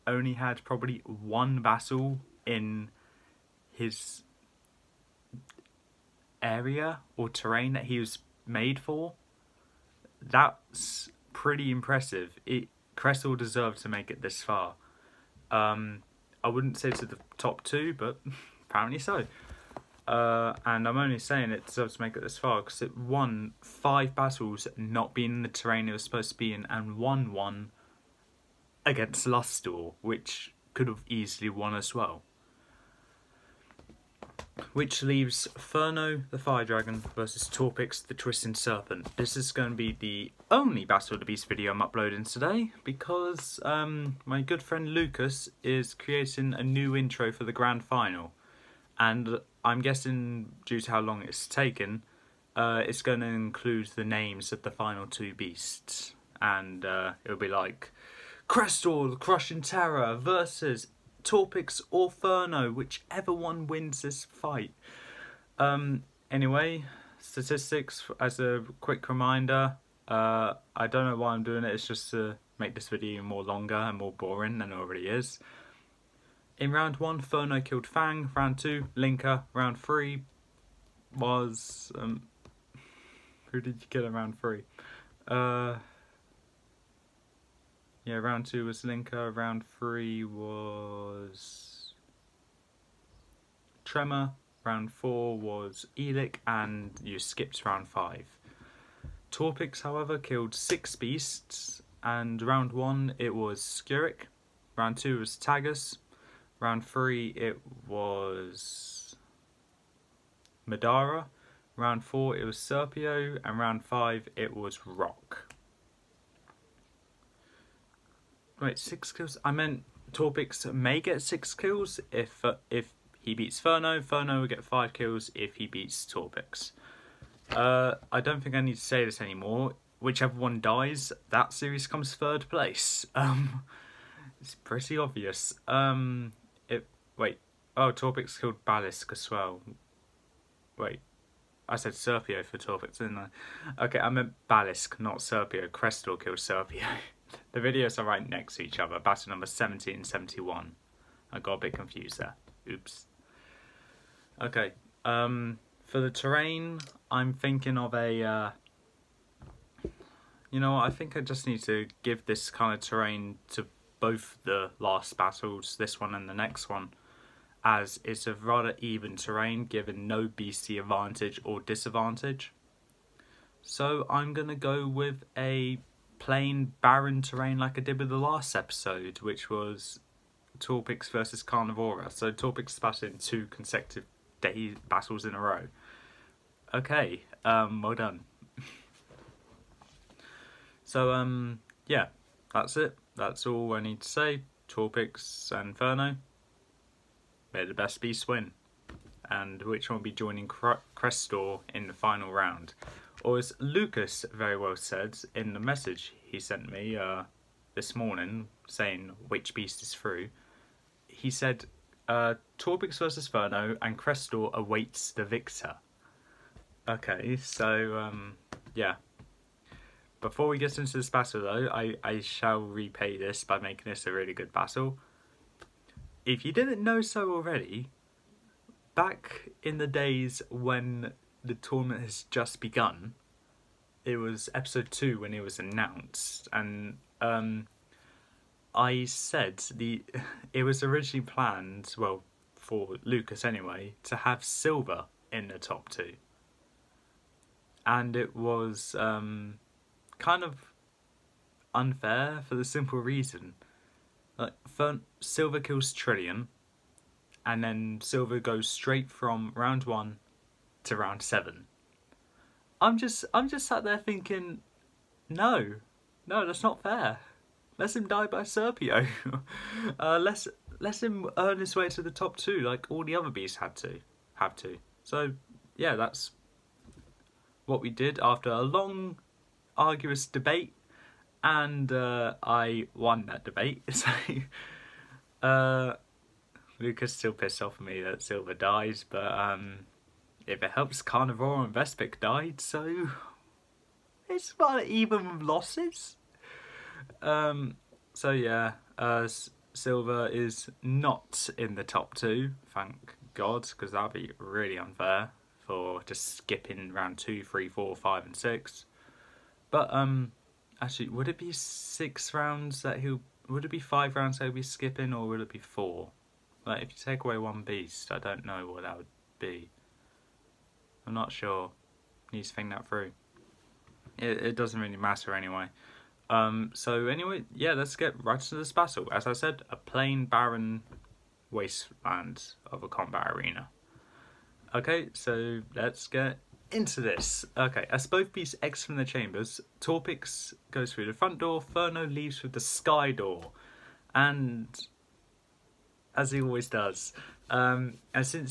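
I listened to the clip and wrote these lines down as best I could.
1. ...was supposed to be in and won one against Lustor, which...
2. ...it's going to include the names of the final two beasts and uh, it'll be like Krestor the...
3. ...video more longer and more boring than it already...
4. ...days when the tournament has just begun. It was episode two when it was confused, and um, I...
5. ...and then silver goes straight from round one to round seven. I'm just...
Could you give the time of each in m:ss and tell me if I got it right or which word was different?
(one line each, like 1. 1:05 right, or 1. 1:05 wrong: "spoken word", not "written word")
1. 0:25 right
2. 0:52 right
3. 1:12 right
4. 3:49 wrong: "announced", not "confused"
5. 4:17 right.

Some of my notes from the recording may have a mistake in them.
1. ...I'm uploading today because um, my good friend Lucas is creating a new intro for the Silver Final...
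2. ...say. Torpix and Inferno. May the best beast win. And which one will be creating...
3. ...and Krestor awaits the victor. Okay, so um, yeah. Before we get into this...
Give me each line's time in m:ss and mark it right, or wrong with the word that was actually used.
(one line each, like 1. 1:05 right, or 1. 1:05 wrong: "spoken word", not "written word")
1. 0:41 wrong: "Grand", not "Silver"
2. 3:14 wrong: "joining", not "creating"
3. 3:33 right.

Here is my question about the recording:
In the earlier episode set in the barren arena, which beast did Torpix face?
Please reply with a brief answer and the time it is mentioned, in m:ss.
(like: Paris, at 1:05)
Carnivora, at 3:01.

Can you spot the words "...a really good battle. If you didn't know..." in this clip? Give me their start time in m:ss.
3:44.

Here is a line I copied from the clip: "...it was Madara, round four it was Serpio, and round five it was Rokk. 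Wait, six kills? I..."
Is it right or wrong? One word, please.
right.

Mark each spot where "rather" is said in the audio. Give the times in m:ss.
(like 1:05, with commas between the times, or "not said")
2:48.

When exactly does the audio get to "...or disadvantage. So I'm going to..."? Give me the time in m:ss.
2:51.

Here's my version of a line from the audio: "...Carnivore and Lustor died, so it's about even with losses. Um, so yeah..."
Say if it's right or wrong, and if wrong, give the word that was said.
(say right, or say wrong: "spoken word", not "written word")
wrong: "Vespick", not "Lustor".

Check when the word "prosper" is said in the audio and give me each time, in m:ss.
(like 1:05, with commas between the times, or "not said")
not said.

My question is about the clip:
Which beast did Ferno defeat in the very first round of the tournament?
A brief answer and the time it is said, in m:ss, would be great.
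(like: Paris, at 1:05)
Fang, at 1:17.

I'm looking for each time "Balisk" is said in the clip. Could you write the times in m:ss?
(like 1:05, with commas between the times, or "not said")
2:18, 2:24.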